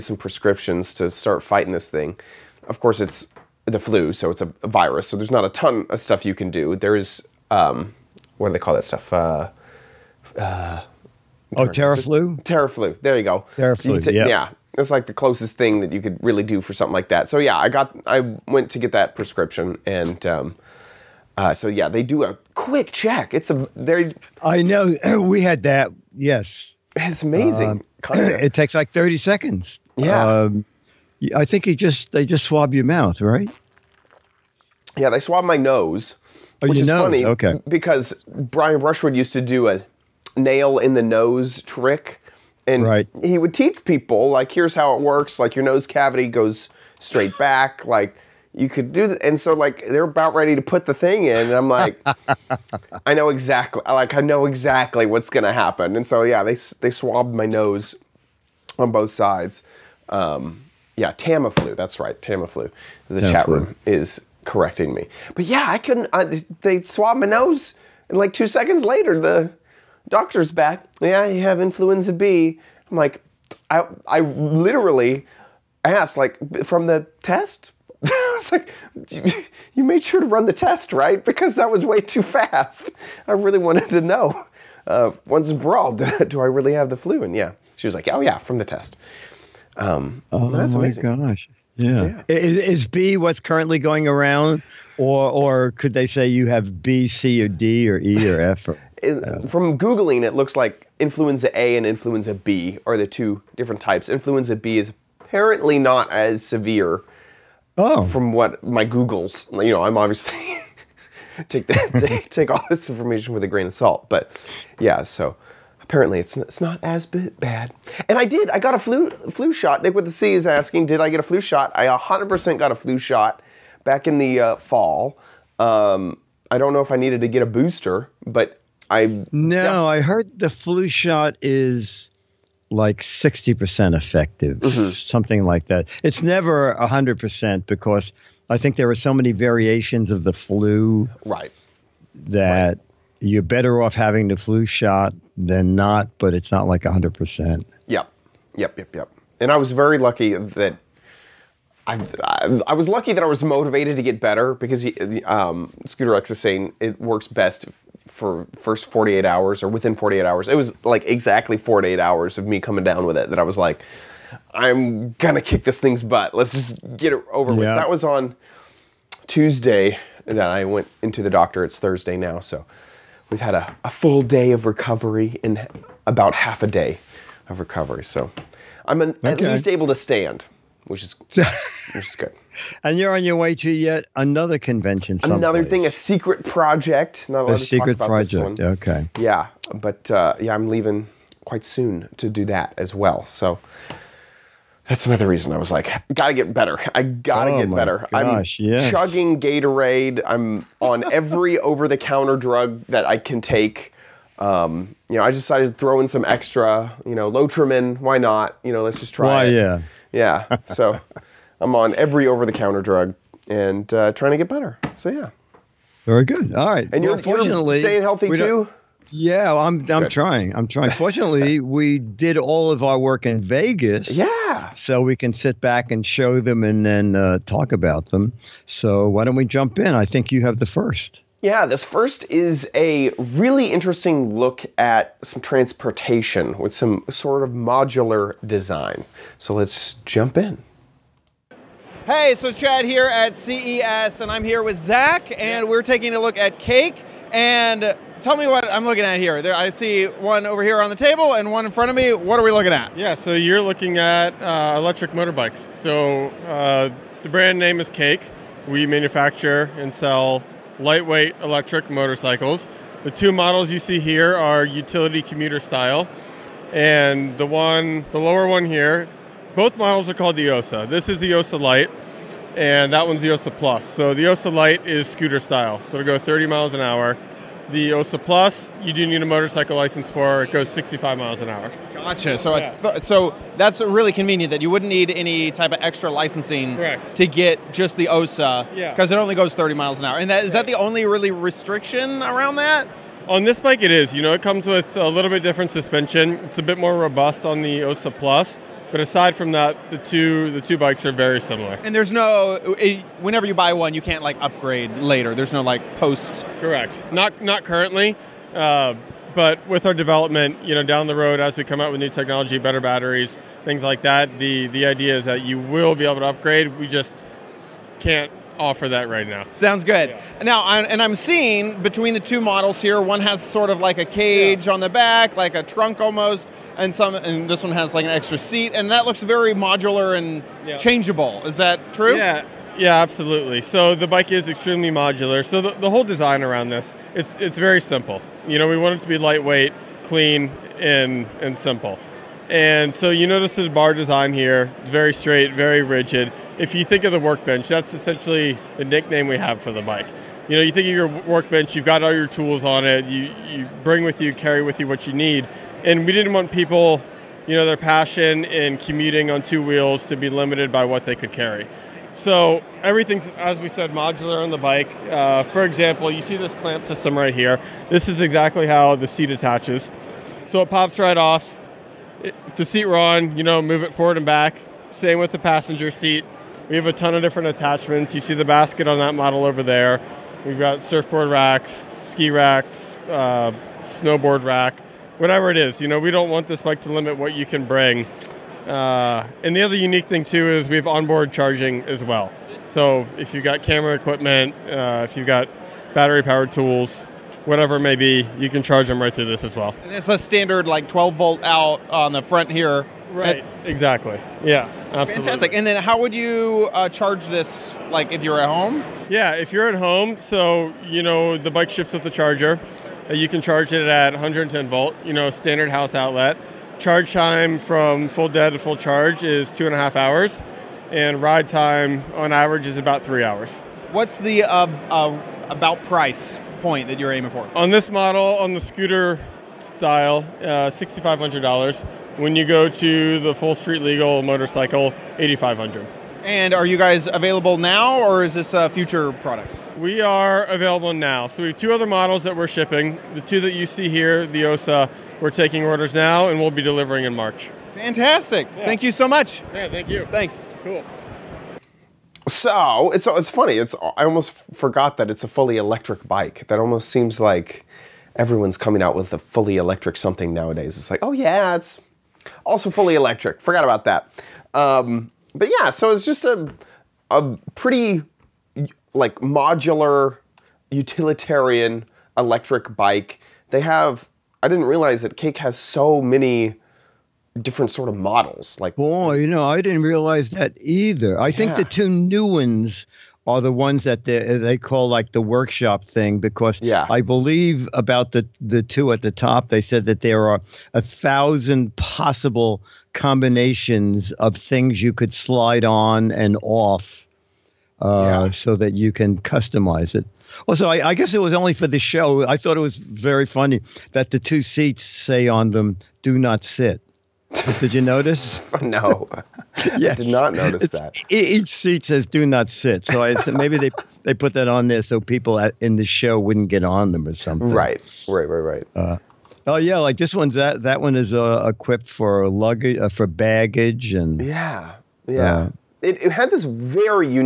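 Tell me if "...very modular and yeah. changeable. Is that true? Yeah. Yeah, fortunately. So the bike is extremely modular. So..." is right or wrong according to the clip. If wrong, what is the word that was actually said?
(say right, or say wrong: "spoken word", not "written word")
wrong: "absolutely", not "fortunately".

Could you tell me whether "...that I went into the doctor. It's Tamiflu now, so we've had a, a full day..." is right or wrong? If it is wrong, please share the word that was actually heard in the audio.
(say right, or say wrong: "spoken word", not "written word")
wrong: "Thursday", not "Tamiflu".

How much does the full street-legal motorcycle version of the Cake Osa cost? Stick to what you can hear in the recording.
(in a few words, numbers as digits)
$8,500.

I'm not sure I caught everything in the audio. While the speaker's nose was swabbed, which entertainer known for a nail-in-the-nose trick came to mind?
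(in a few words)
Brian Brushwood.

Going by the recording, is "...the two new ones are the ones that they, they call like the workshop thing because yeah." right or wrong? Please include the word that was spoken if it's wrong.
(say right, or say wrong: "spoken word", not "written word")
right.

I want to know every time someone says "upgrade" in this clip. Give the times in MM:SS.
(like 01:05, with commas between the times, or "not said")
05:04, 05:16.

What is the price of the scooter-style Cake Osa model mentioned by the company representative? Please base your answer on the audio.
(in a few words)
$6,500.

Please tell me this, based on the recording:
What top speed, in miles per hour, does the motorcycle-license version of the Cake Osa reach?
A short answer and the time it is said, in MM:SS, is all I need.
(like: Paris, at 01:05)
65, at 04:40.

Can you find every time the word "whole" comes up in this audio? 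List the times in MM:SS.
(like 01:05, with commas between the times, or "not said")
05:35.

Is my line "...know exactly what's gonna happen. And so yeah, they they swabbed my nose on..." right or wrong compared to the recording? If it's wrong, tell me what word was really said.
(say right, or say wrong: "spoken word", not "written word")
right.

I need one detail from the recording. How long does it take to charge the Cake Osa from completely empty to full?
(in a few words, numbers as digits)
2.5 hours.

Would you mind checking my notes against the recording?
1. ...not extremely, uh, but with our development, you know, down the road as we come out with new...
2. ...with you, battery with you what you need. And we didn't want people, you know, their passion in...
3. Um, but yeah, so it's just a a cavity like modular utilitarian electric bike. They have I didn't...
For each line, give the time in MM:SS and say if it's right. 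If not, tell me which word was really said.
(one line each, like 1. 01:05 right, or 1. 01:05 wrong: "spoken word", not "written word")
1. 05:07 wrong: "currently", not "extremely"
2. 05:54 wrong: "carry", not "battery"
3. 07:44 wrong: "pretty", not "cavity".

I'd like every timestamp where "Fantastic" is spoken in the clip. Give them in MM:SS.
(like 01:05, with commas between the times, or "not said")
06:45, 07:27.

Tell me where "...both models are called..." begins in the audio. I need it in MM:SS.
04:29.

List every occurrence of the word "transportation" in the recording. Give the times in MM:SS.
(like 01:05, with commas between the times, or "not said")
03:55.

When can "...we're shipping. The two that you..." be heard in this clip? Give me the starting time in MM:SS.
07:22.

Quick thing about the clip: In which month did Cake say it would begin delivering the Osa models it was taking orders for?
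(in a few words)
March.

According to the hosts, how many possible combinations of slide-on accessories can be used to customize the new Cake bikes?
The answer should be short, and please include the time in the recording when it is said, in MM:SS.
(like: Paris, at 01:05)
1,000, at 08:10.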